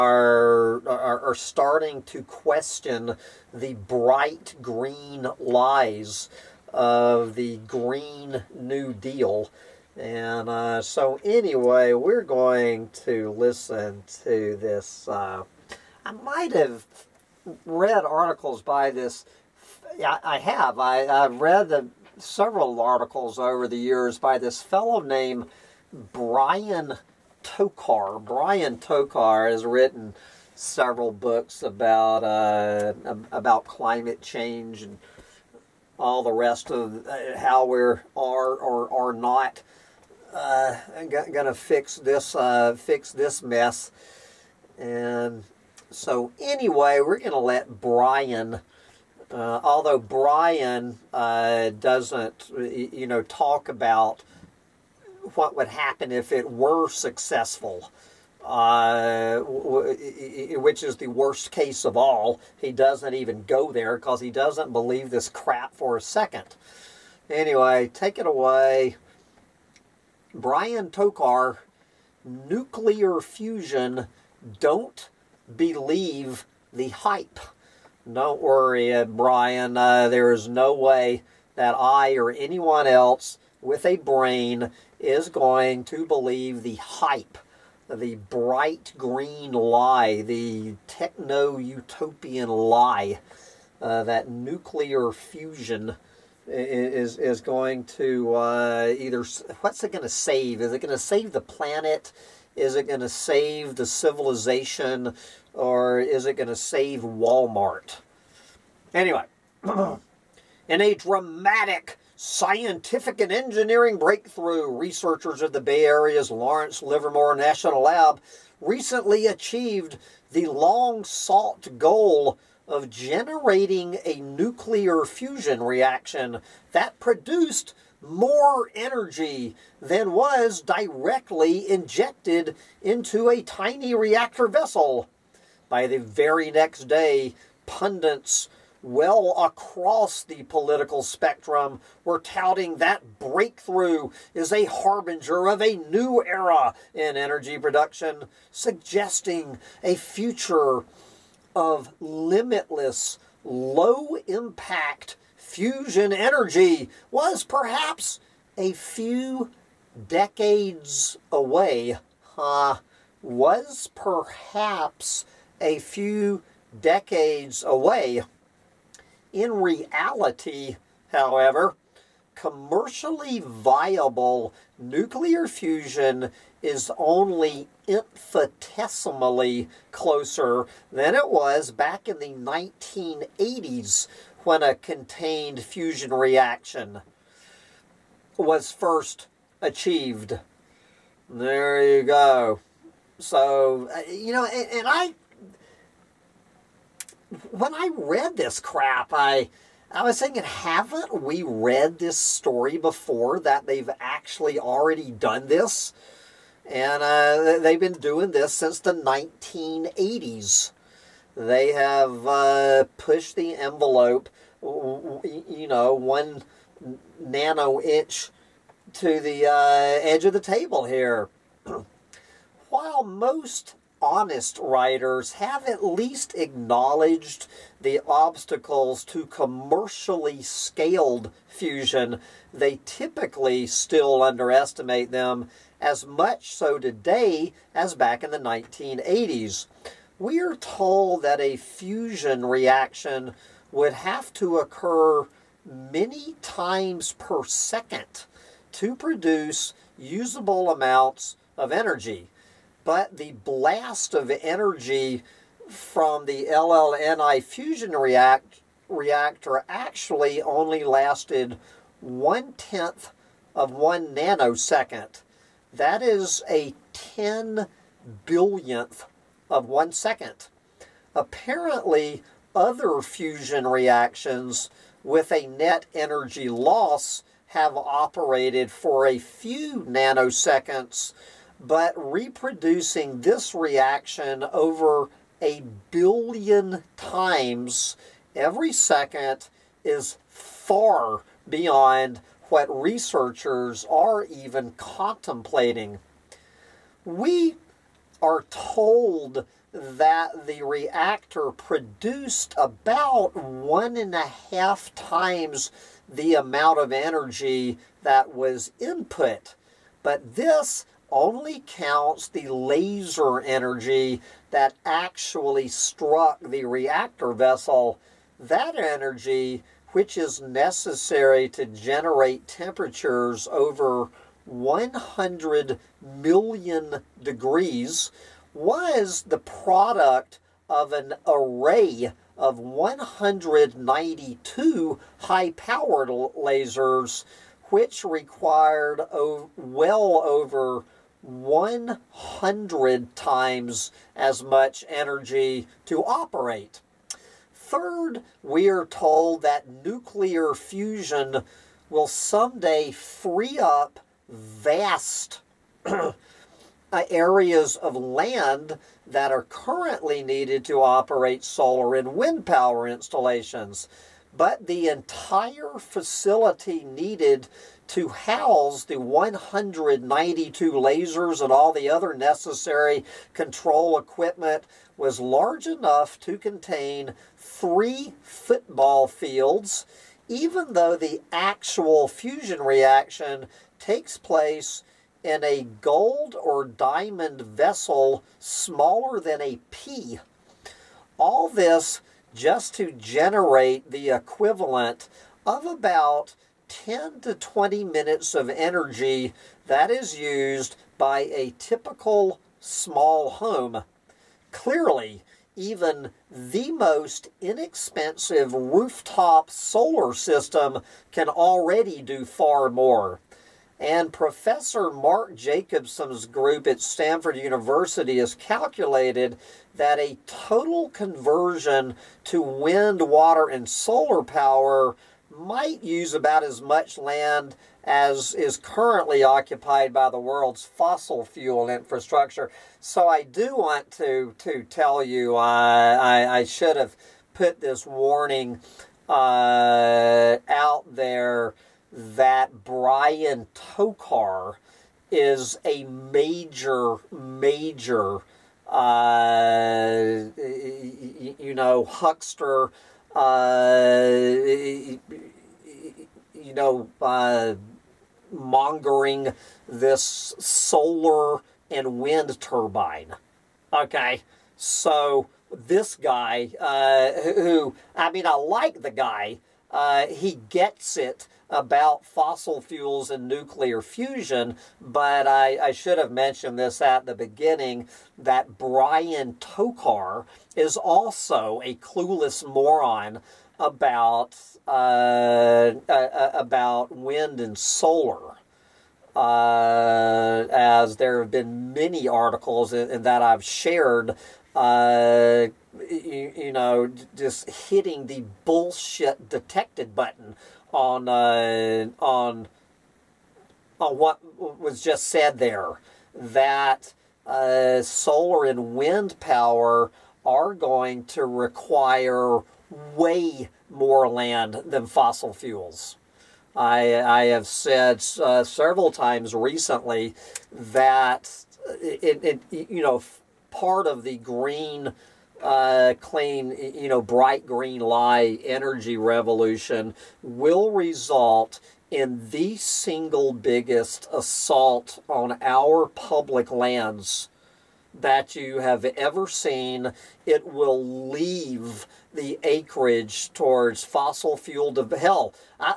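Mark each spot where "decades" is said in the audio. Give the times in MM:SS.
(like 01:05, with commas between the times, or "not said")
02:40, 02:46.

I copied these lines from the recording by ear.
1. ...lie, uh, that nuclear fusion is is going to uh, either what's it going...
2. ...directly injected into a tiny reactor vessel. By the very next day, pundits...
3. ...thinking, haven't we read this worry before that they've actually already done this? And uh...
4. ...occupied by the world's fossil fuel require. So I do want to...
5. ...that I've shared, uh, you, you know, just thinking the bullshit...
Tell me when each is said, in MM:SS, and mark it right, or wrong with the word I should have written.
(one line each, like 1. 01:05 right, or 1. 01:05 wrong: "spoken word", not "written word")
1. 01:32 right
2. 02:10 right
3. 03:20 wrong: "story", not "worry"
4. 07:09 wrong: "infrastructure", not "require"
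5. 08:13 wrong: "hitting", not "thinking".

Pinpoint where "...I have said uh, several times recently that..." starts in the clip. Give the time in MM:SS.
08:37.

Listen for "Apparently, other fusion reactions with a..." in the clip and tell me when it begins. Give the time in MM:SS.
04:31.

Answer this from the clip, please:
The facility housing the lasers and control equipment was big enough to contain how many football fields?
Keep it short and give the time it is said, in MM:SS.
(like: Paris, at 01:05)
3, at 06:17.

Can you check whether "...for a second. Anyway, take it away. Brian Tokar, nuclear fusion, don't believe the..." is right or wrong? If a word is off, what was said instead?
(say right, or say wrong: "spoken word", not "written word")
right.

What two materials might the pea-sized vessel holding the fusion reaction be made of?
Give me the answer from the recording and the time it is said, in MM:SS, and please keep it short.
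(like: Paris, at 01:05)
gold or diamond, at 06:25.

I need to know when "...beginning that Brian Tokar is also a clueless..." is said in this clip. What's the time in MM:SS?
07:57.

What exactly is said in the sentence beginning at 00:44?
And so anyway, we're going to let Brian.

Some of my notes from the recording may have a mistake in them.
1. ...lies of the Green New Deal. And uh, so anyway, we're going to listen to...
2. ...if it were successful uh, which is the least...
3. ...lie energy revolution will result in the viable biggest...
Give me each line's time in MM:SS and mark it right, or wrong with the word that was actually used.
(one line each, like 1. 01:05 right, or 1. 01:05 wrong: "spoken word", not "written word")
1. 00:05 right
2. 00:56 wrong: "worst", not "least"
3. 08:47 wrong: "single", not "viable".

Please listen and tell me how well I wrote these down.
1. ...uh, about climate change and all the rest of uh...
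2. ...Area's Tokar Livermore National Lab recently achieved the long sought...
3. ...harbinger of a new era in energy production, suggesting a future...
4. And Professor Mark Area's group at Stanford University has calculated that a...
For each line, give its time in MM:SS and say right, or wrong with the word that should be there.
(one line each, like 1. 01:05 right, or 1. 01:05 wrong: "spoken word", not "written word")
1. 00:32 right
2. 01:55 wrong: "Lawrence", not "Tokar"
3. 02:24 right
4. 06:53 wrong: "Jacobson", not "Area".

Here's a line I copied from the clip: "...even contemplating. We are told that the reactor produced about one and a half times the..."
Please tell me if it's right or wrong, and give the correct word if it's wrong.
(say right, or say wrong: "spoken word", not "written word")
right.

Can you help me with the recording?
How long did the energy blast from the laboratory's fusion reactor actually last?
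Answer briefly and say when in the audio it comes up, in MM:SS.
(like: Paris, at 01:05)
one-tenth of one nanosecond, at 04:22.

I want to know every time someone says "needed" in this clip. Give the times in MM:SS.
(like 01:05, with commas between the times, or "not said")
06:00, 06:06.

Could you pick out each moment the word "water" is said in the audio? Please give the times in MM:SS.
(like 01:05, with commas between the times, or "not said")
07:03.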